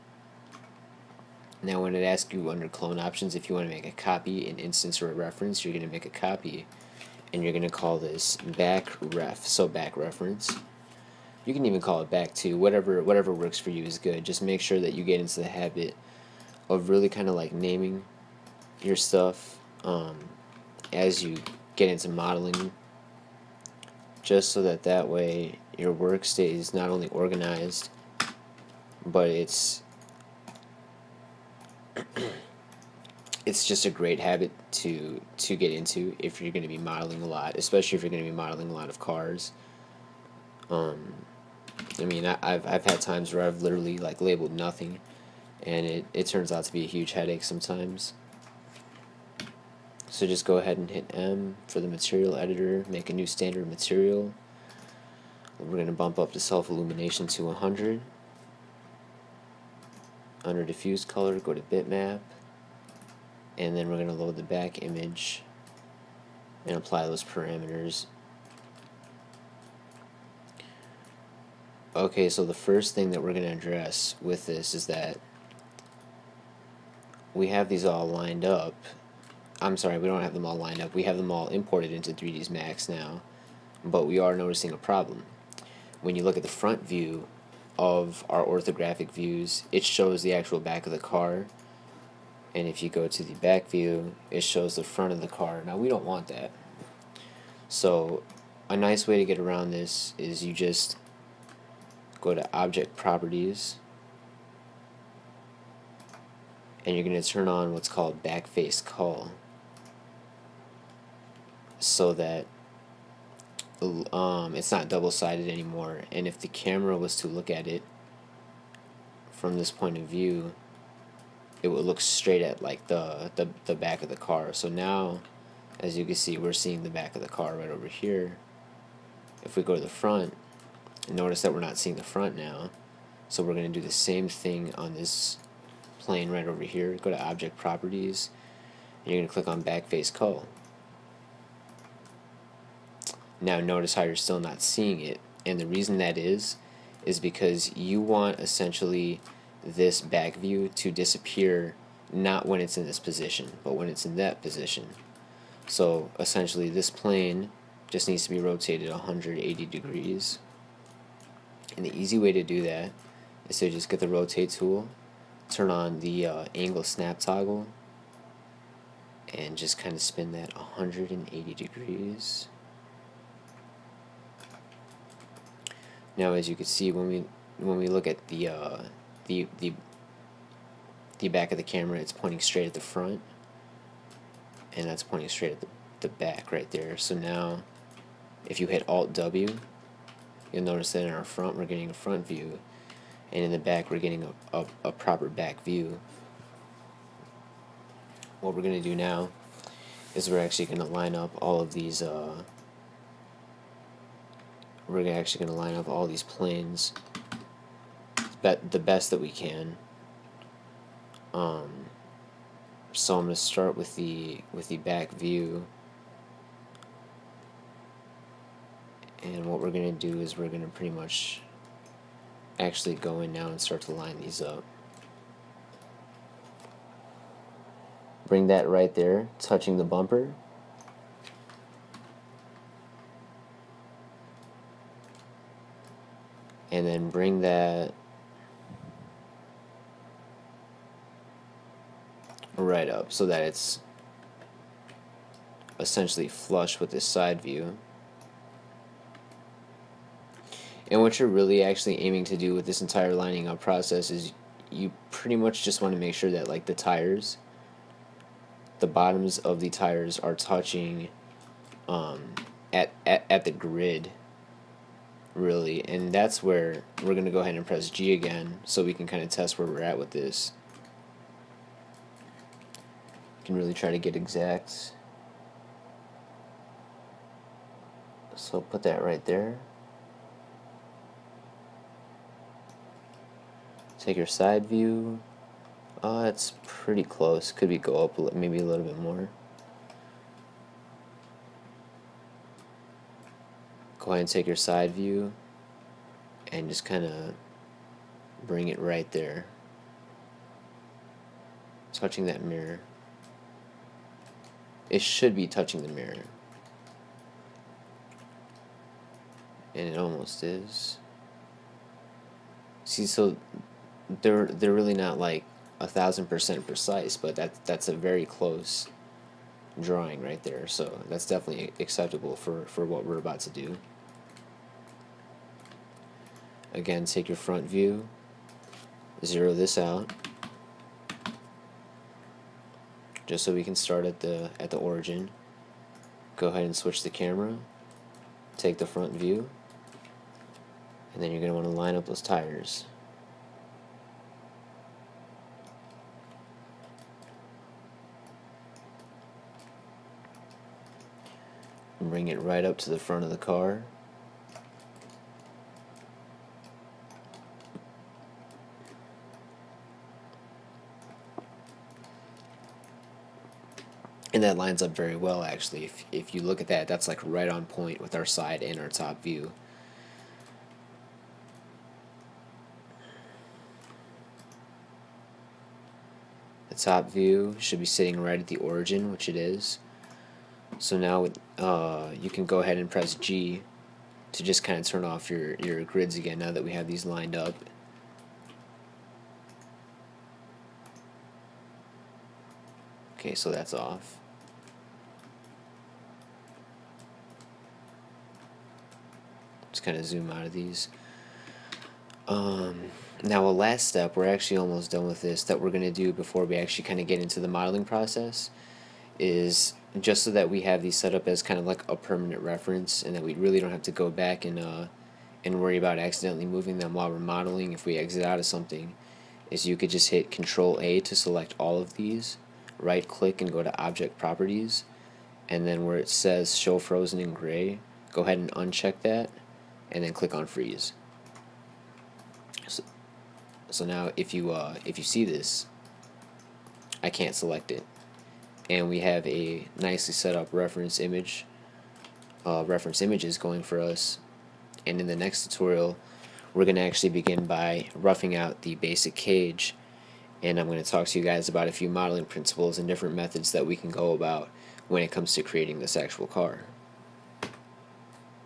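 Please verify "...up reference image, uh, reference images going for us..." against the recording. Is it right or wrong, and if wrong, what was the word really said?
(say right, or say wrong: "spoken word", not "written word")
right.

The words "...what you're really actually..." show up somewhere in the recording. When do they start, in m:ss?
4:11.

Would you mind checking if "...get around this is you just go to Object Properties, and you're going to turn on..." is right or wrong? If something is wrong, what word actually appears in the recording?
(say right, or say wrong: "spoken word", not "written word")
right.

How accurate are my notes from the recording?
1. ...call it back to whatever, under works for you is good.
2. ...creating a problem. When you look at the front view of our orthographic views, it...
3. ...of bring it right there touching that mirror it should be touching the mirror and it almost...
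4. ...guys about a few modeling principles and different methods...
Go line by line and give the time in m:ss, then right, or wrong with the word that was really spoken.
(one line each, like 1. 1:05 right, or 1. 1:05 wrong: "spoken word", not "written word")
1. 0:11 wrong: "whatever", not "under"
2. 1:24 wrong: "noticing", not "creating"
3. 4:57 right
4. 7:31 right.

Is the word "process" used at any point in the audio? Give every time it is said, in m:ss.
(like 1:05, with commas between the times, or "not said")
4:13, 6:47.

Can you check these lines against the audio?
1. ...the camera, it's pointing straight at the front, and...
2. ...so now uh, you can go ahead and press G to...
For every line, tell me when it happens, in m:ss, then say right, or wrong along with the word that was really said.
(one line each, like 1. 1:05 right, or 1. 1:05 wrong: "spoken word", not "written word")
1. 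3:01 right
2. 6:20 right.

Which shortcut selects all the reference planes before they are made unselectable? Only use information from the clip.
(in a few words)
Control A.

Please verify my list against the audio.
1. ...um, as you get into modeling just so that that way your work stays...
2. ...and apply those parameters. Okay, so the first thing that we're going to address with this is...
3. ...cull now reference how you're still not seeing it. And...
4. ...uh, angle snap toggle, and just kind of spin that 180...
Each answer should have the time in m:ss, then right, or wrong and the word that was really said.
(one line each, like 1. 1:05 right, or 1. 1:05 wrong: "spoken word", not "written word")
1. 0:19 right
2. 1:06 right
3. 2:20 wrong: "notice", not "reference"
4. 2:46 right.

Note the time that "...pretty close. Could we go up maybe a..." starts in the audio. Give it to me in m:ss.
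4:46.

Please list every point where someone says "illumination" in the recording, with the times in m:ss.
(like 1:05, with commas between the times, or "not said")
0:56.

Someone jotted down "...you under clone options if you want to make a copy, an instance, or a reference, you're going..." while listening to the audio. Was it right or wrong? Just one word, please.
right.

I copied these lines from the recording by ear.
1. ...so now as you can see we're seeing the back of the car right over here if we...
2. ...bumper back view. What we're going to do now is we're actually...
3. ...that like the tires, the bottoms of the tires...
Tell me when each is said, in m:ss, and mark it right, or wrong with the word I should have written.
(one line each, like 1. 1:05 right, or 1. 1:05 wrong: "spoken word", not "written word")
1. 2:04 right
2. 3:14 wrong: "proper", not "bumper"
3. 4:16 right.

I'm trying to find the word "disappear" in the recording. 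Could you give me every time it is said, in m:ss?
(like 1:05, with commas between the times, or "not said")
2:30.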